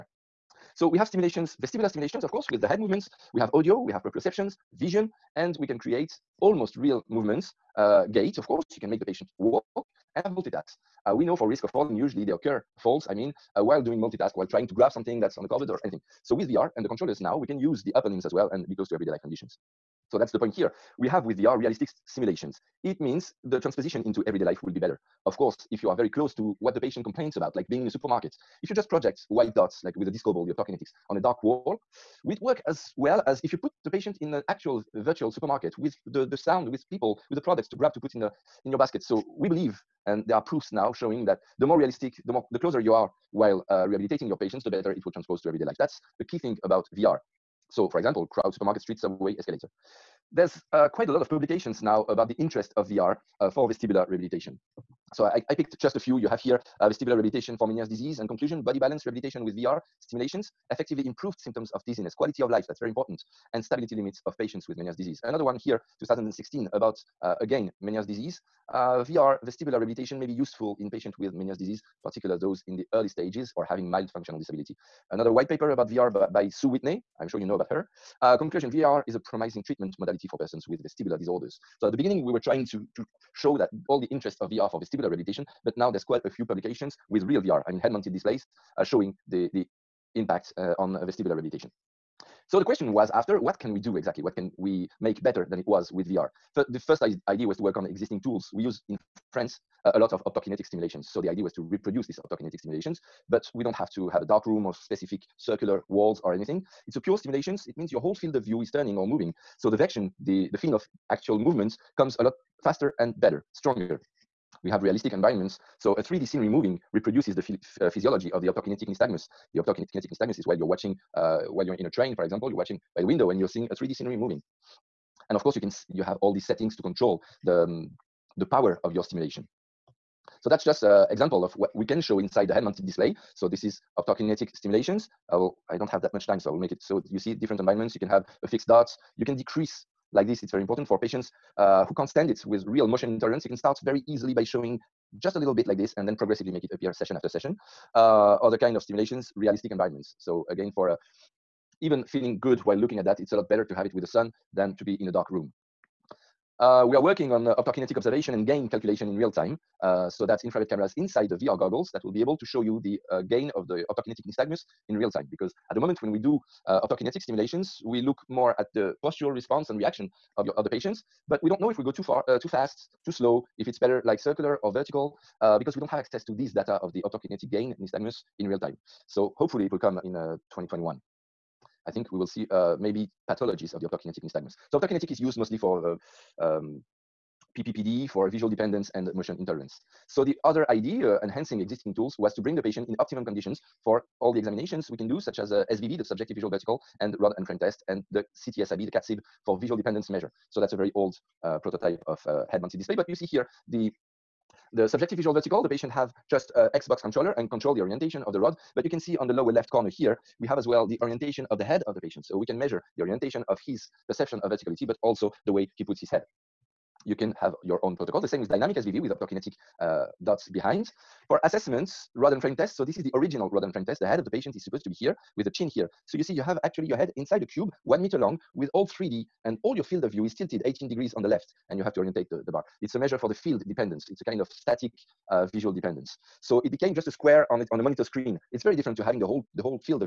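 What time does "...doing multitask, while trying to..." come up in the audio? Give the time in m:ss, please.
0:13.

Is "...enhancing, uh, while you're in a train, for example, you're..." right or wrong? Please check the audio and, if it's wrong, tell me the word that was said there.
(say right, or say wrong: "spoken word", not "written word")
wrong: "watching", not "enhancing".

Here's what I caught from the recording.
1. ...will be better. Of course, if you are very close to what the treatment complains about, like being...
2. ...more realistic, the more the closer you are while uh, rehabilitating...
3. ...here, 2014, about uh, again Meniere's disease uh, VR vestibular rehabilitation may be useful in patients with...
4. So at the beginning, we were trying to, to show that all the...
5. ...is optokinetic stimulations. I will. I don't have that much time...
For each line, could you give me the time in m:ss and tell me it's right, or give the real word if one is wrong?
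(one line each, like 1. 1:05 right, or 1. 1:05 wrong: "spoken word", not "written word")
1. 0:24 wrong: "patient", not "treatment"
2. 0:41 right
3. 1:05 wrong: "2016", not "2014"
4. 1:21 right
5. 2:13 right.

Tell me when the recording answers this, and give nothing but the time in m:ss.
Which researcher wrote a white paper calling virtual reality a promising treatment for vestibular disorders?
1:16.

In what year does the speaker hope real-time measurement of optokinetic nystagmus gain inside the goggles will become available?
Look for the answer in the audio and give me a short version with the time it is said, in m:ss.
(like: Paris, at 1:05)
2021, at 3:00.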